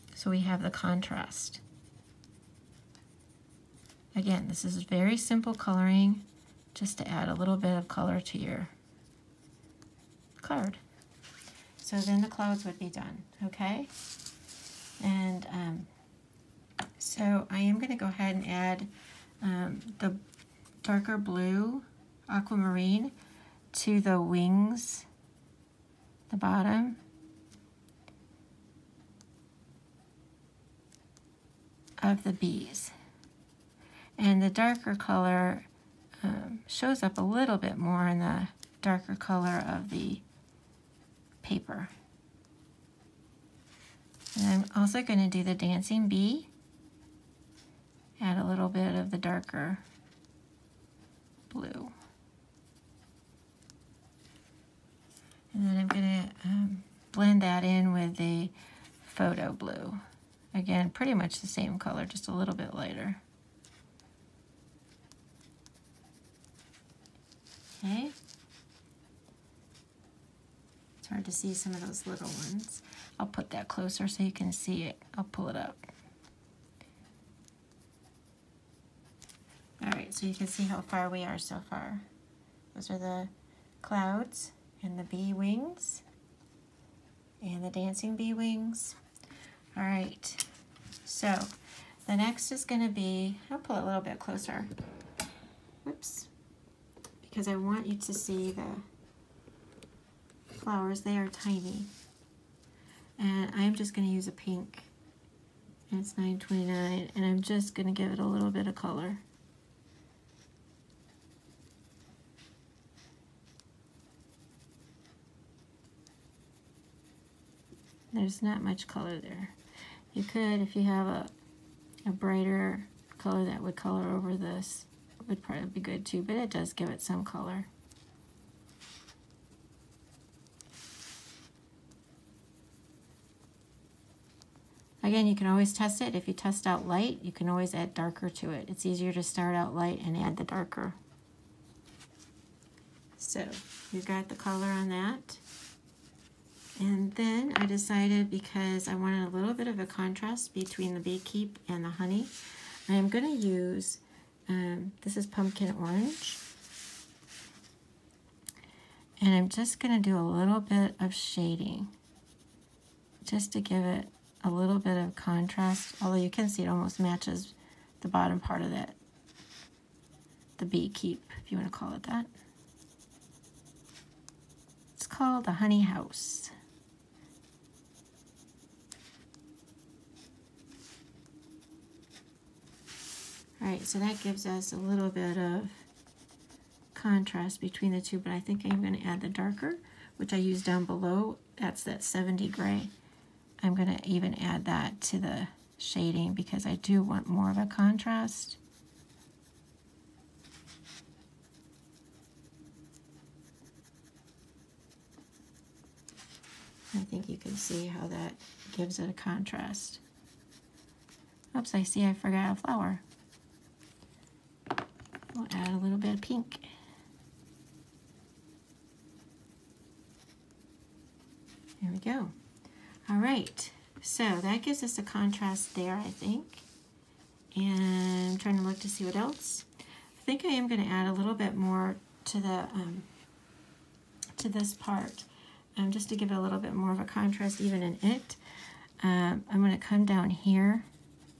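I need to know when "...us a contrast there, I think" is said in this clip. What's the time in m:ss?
3:44.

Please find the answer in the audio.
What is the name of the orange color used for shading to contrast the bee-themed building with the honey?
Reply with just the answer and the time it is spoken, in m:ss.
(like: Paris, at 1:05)
pumpkin orange, at 2:35.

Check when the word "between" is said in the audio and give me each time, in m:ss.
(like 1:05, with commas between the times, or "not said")
2:30, 3:07.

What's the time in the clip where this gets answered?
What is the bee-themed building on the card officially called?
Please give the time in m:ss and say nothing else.
2:55.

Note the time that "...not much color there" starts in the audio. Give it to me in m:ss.
1:58.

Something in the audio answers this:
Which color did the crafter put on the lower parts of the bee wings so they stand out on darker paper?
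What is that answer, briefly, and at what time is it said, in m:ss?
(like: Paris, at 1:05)
darker blue aquamarine, at 0:20.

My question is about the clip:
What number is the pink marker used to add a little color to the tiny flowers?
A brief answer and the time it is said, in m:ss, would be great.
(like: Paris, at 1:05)
9.29, at 1:46.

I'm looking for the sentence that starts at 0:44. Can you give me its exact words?
And I'm also going to do the dancing bee.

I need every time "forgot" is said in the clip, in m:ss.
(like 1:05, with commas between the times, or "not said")
3:32.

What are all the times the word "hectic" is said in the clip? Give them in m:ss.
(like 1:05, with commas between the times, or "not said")
not said.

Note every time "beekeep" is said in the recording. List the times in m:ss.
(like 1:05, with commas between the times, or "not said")
2:30, 2:50.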